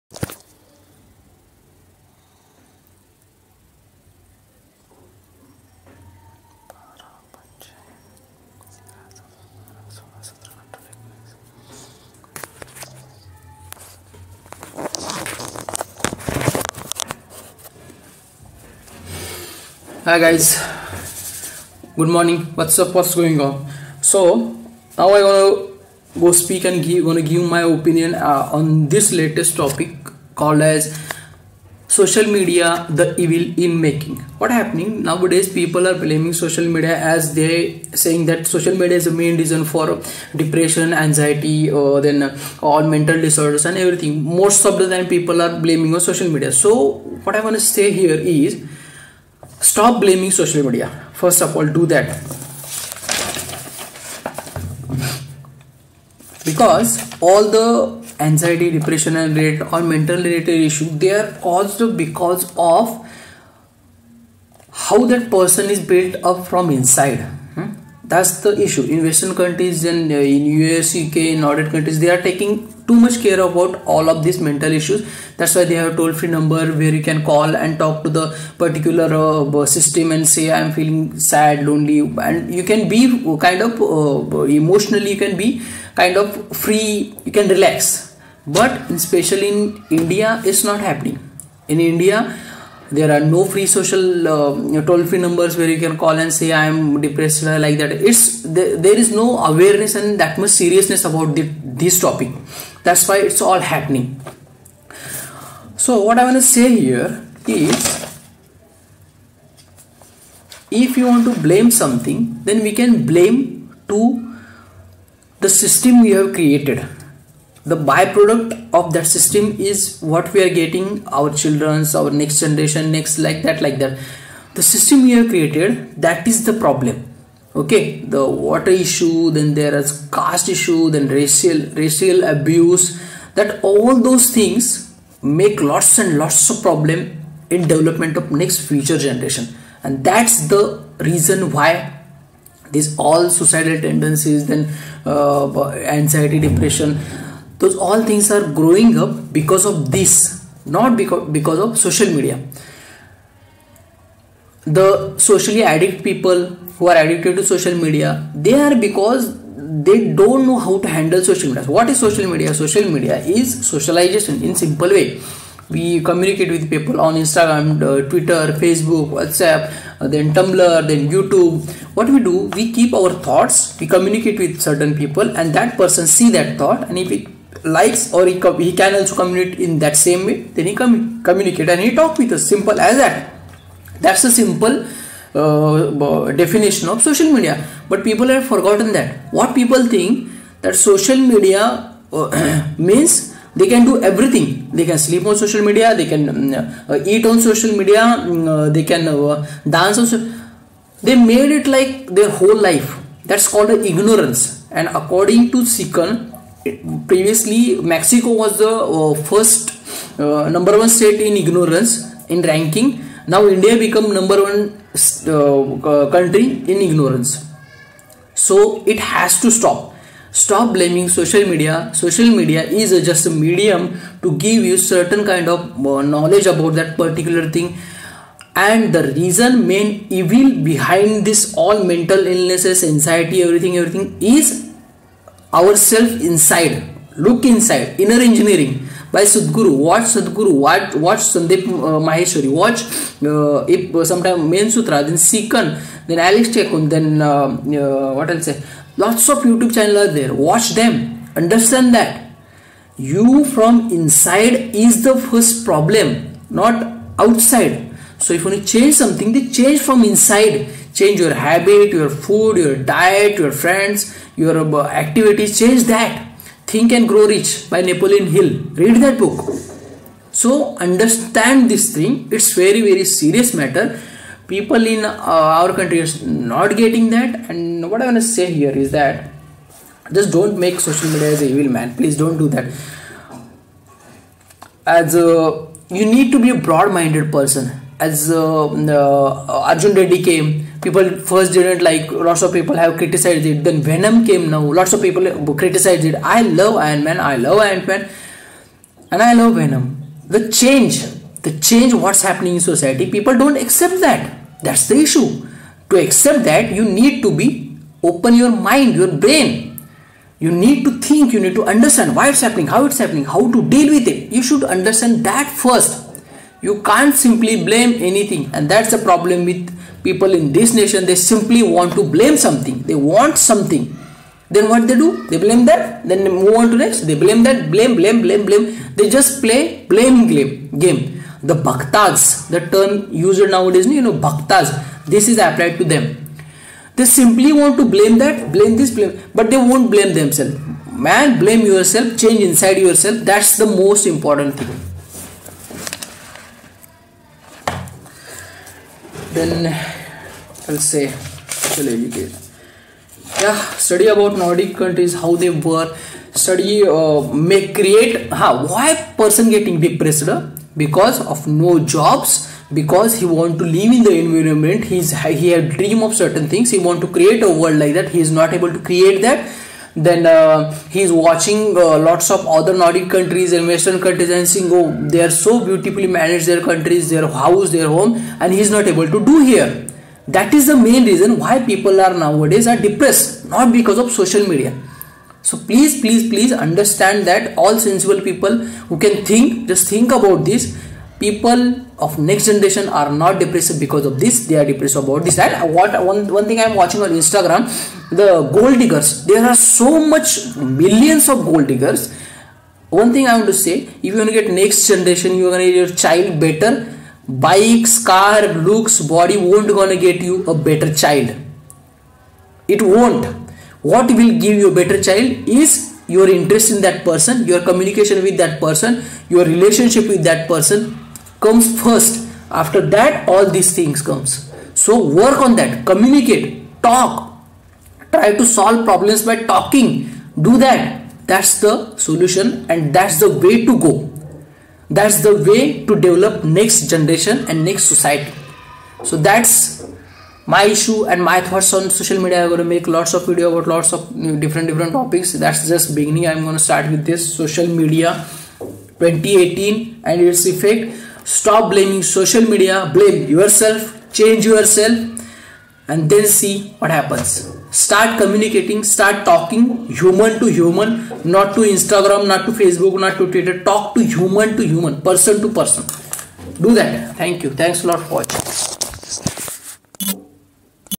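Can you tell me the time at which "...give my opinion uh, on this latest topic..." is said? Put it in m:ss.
0:27.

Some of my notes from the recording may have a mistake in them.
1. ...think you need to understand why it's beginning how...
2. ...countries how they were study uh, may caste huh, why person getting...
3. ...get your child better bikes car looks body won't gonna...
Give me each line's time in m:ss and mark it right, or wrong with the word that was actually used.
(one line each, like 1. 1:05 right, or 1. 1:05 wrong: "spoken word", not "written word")
1. 5:11 wrong: "happening", not "beginning"
2. 5:54 wrong: "create", not "caste"
3. 6:45 right.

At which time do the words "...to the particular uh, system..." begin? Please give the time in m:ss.
1:18.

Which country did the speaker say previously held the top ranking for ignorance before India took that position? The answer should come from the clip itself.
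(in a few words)
Mexico.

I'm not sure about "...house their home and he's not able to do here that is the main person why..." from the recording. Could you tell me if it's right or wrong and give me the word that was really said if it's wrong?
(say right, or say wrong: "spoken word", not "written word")
wrong: "reason", not "person".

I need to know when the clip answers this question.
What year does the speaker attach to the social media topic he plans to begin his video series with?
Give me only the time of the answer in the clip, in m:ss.
7:28.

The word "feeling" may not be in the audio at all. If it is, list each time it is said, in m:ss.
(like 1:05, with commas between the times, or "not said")
1:20.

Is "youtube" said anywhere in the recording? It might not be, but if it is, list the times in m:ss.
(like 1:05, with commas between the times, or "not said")
2:51, 4:09.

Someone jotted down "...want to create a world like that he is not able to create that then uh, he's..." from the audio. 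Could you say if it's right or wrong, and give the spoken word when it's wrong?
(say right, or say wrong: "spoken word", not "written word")
right.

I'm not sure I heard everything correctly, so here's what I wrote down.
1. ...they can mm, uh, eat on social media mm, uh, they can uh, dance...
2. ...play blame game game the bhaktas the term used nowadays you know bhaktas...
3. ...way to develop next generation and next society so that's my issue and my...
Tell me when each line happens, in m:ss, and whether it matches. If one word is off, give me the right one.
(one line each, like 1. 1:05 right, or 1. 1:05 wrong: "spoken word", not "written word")
1. 3:15 right
2. 5:29 right
3. 7:15 right.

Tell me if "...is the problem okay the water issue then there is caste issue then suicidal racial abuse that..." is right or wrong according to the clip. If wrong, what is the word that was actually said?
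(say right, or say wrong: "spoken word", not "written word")
wrong: "racial", not "suicidal".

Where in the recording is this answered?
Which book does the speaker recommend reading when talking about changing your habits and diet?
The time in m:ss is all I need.
4:26.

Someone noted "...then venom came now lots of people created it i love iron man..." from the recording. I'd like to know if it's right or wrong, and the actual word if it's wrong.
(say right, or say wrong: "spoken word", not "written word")
wrong: "criticized", not "created".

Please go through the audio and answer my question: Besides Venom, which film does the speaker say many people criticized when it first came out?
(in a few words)
Arjun Reddy.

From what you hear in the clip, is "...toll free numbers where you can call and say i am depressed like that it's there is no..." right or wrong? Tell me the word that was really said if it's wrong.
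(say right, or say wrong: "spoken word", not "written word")
right.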